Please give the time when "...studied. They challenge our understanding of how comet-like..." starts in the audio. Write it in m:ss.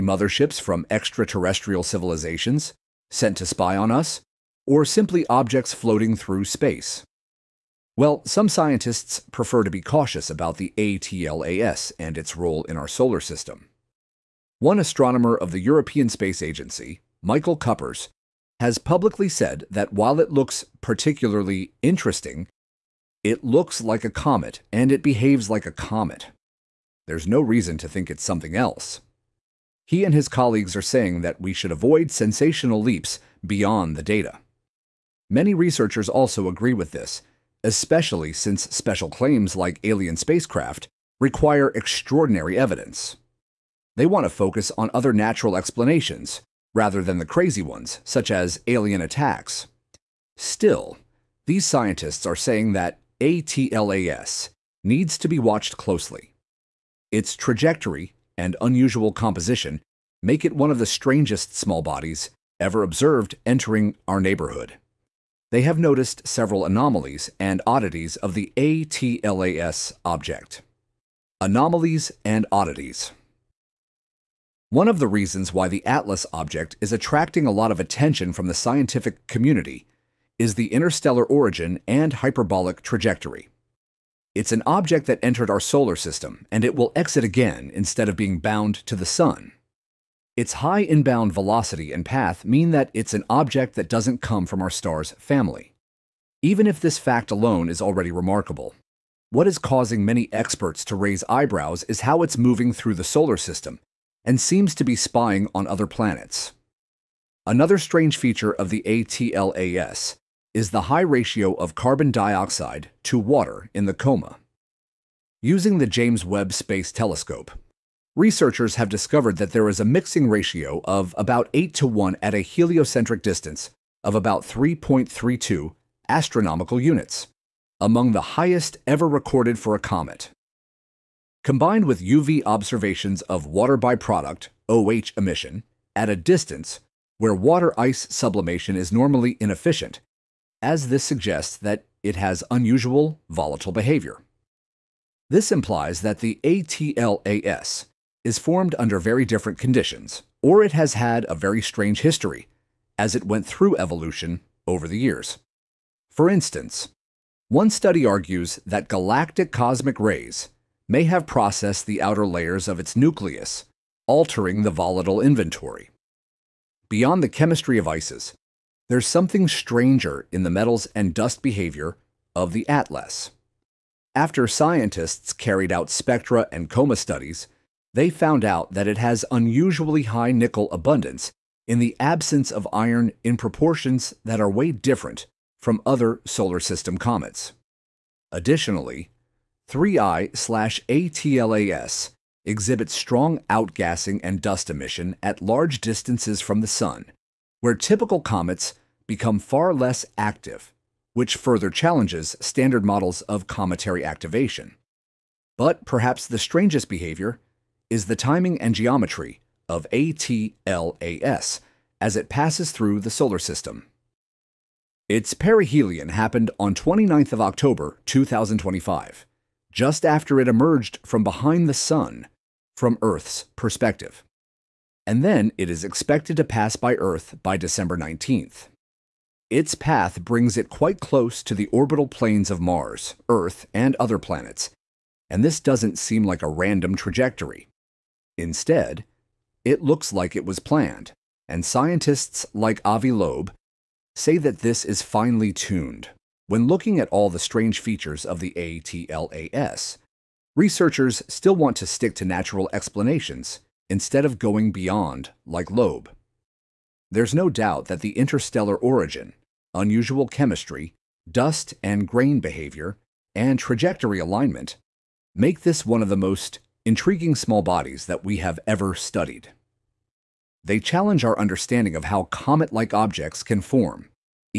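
4:28.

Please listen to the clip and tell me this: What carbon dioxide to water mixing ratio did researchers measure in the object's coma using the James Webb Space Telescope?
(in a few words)
8 to 1.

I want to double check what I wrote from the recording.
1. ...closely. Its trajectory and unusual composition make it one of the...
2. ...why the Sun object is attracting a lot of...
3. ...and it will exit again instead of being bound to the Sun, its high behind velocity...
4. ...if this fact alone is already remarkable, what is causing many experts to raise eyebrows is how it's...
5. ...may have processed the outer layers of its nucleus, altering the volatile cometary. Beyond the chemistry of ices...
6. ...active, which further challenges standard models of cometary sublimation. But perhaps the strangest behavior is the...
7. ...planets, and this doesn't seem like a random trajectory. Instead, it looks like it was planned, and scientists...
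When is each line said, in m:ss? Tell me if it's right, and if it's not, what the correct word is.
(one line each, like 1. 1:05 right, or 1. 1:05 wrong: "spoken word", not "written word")
1. 0:55 right
2. 1:15 wrong: "ATLAS", not "Sun"
3. 1:26 wrong: "inbound", not "behind"
4. 1:36 right
5. 2:40 wrong: "inventory", not "cometary"
6. 3:20 wrong: "activation", not "sublimation"
7. 3:54 right.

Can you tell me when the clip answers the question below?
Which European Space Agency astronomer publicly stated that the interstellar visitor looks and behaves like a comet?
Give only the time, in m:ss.
0:17.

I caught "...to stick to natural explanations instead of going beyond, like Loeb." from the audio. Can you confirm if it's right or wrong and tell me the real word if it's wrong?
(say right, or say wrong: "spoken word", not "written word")
right.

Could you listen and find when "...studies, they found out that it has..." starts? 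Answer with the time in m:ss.
2:56.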